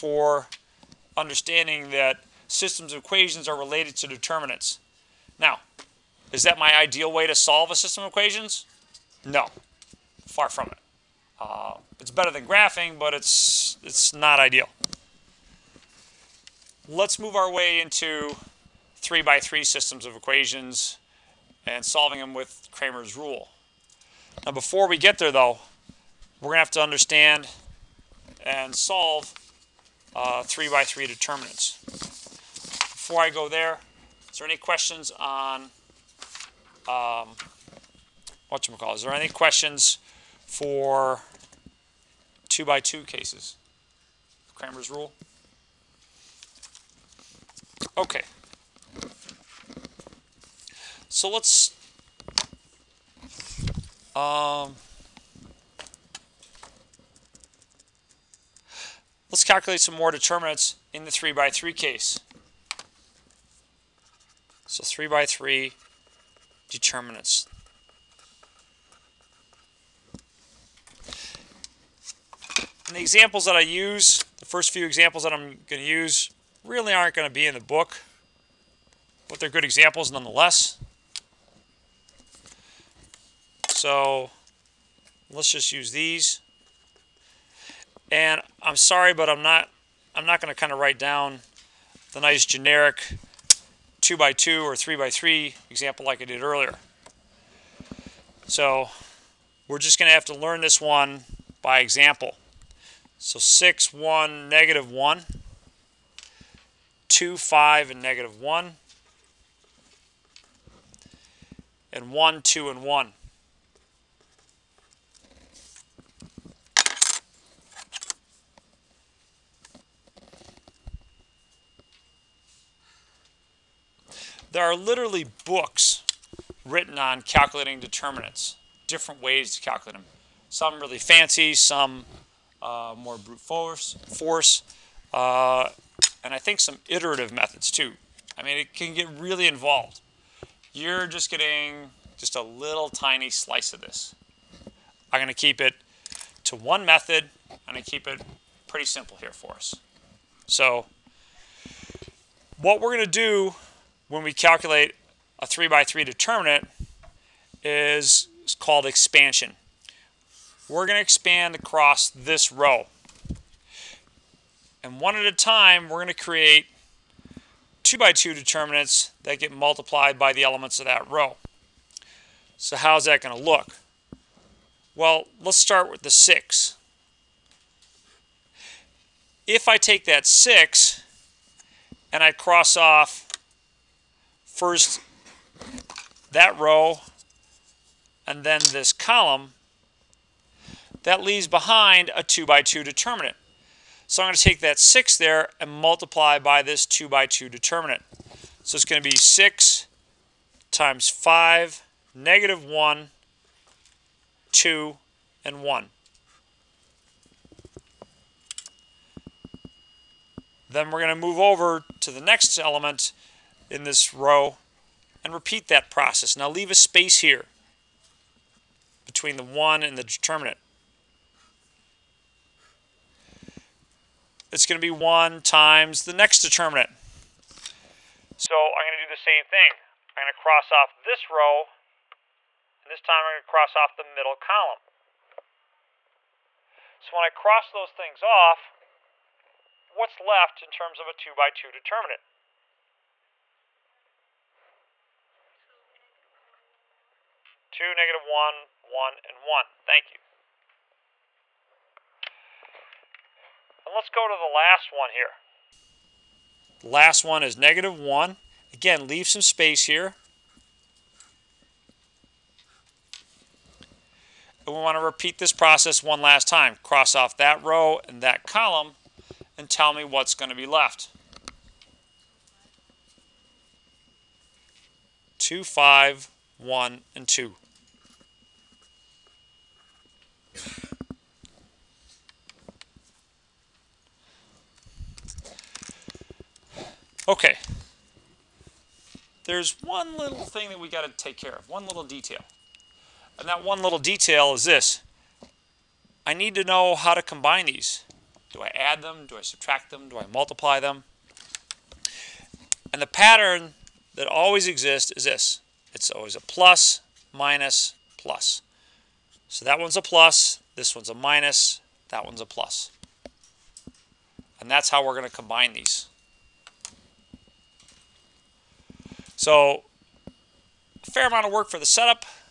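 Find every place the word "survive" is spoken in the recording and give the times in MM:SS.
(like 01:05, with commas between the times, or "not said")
not said.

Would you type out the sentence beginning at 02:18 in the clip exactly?
I mean, it can get really involved.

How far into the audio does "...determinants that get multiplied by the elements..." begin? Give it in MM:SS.
02:48.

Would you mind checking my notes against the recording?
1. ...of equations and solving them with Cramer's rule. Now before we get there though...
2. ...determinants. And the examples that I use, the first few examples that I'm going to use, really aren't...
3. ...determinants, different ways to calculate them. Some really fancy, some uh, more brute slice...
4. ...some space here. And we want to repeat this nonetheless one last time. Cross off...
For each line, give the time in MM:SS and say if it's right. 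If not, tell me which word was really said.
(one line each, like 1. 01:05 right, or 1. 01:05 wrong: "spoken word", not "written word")
1. 00:20 right
2. 01:06 right
3. 02:07 wrong: "force", not "slice"
4. 04:19 wrong: "process", not "nonetheless".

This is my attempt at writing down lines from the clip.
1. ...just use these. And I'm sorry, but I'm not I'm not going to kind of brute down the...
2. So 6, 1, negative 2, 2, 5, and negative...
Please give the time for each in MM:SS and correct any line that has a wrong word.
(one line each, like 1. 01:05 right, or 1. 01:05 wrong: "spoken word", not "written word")
1. 01:25 wrong: "write", not "brute"
2. 01:43 wrong: "1", not "2".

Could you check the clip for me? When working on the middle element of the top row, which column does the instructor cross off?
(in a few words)
the middle column.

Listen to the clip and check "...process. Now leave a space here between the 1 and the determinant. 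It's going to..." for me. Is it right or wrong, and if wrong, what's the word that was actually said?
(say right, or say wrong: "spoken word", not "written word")
right.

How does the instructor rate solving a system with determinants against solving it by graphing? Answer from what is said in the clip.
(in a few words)
better than graphing.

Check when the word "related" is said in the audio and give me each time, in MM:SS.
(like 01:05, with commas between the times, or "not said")
00:03.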